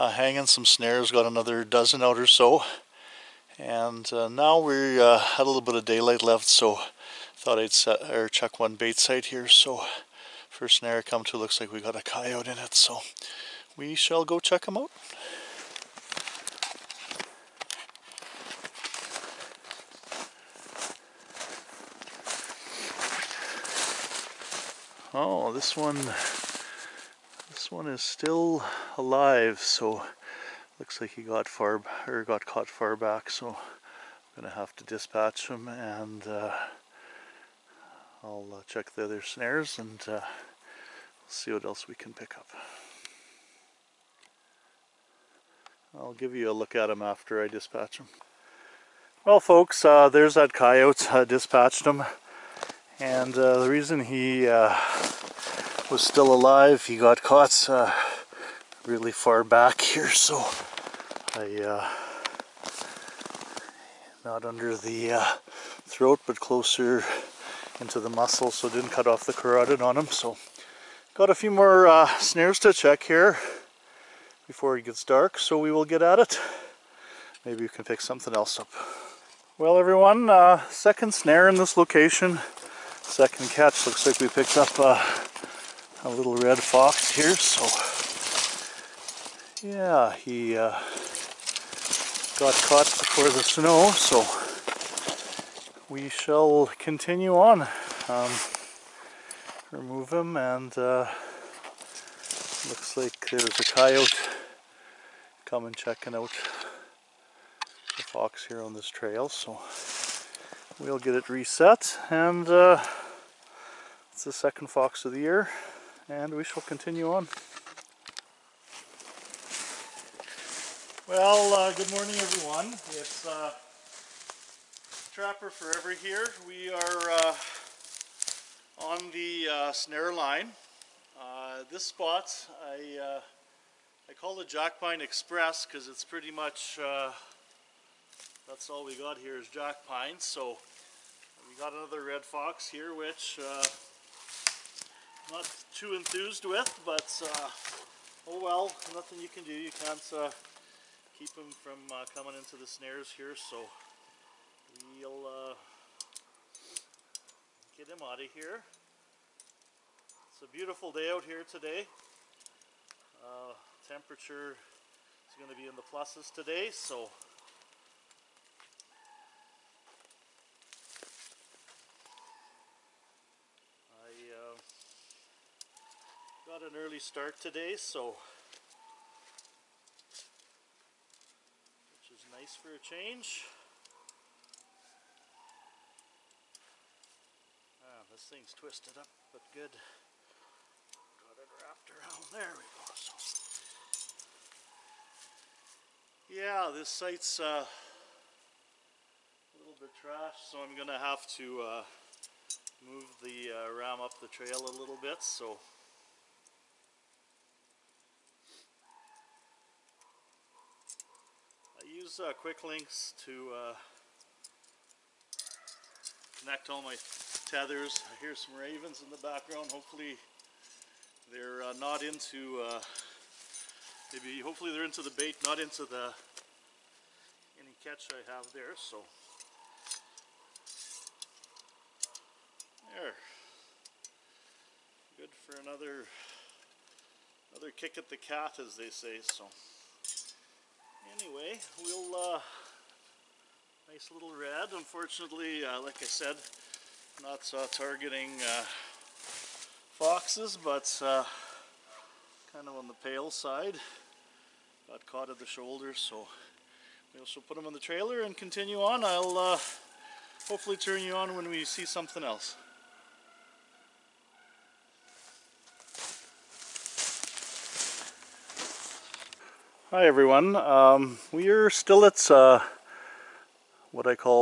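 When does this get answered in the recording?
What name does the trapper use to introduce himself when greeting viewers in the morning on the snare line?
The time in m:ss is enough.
2:05.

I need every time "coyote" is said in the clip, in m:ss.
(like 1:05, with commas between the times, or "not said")
0:12, 0:50, 1:43.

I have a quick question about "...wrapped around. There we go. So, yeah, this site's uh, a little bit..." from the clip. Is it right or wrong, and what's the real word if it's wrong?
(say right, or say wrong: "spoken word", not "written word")
right.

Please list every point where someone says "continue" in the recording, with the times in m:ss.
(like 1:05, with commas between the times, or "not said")
1:36, 1:56, 4:18.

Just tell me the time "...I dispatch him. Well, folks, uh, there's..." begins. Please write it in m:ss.
0:47.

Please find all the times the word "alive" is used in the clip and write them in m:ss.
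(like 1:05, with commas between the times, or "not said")
0:28, 0:56.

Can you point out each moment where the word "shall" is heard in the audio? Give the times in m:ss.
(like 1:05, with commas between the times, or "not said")
0:13, 1:36, 1:56.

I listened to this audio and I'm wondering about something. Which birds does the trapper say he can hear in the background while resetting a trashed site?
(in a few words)
Ravens.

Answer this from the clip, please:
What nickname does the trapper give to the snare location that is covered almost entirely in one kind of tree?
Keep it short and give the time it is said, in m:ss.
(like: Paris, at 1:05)
Jackpine Express, at 2:14.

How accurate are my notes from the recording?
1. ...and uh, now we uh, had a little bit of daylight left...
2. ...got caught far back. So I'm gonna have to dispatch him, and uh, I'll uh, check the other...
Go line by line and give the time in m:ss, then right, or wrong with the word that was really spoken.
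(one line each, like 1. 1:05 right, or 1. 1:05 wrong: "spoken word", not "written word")
1. 0:03 right
2. 0:32 right.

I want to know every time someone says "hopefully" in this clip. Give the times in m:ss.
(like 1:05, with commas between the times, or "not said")
3:39, 3:44, 4:20.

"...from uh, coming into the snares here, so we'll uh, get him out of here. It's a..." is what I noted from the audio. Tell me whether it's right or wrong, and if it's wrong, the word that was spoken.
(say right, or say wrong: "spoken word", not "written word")
right.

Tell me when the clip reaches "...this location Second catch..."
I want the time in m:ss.
1:21.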